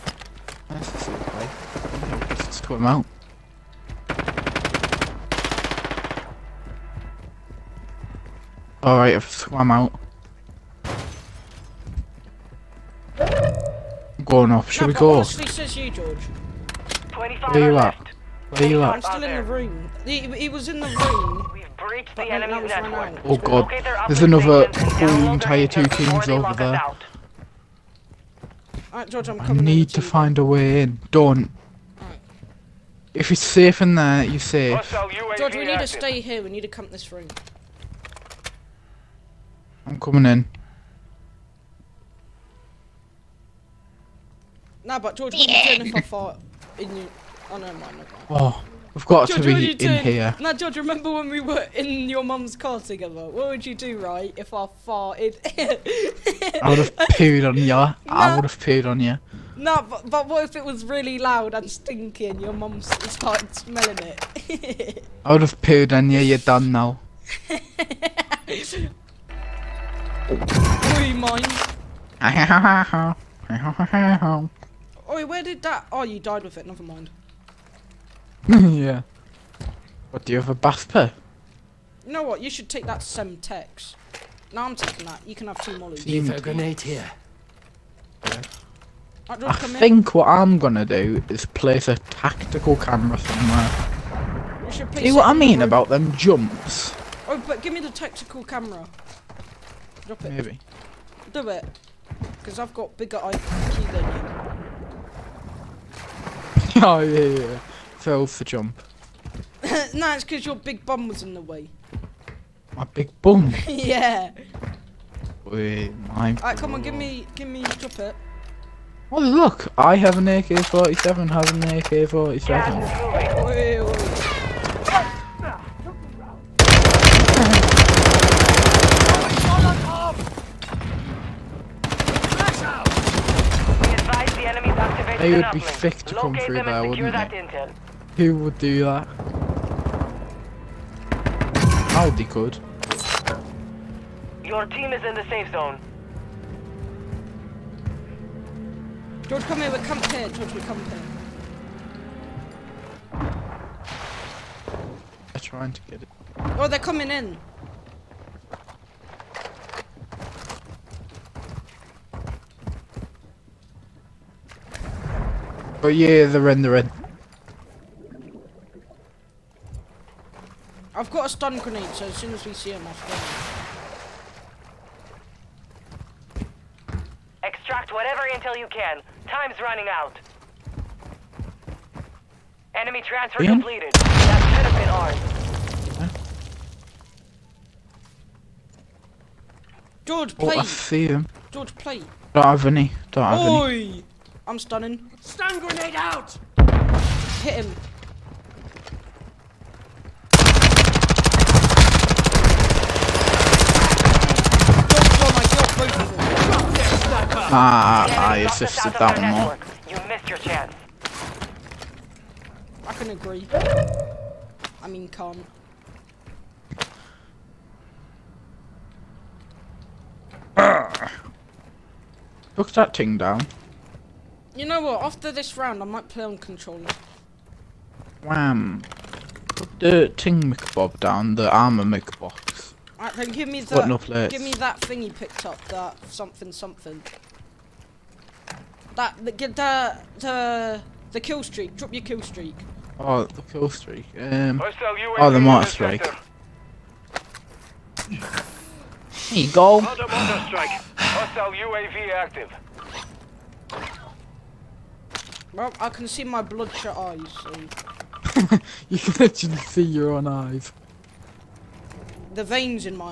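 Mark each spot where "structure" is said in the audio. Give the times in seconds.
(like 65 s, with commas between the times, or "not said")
not said.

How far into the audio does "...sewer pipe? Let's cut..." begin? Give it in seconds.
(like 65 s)
0 s.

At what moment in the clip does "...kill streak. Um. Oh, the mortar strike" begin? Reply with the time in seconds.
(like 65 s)
243 s.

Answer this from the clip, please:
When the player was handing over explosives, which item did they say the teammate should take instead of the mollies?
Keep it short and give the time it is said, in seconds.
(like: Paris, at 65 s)
Semtex, at 83 s.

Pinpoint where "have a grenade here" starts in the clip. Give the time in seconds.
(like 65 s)
86 s.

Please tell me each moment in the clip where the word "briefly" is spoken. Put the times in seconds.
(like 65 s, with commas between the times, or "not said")
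not said.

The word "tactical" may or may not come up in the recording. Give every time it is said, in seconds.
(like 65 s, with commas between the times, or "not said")
91 s, 97 s.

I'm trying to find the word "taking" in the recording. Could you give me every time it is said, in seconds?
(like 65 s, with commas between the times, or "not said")
84 s.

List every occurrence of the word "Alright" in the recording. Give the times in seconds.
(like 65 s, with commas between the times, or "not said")
8 s, 116 s, 232 s.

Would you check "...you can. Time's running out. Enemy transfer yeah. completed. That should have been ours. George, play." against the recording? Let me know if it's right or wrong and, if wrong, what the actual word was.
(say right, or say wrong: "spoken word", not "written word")
right.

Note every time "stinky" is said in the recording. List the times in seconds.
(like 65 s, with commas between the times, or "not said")
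61 s.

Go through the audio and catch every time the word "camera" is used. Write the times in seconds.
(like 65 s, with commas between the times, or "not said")
92 s, 98 s.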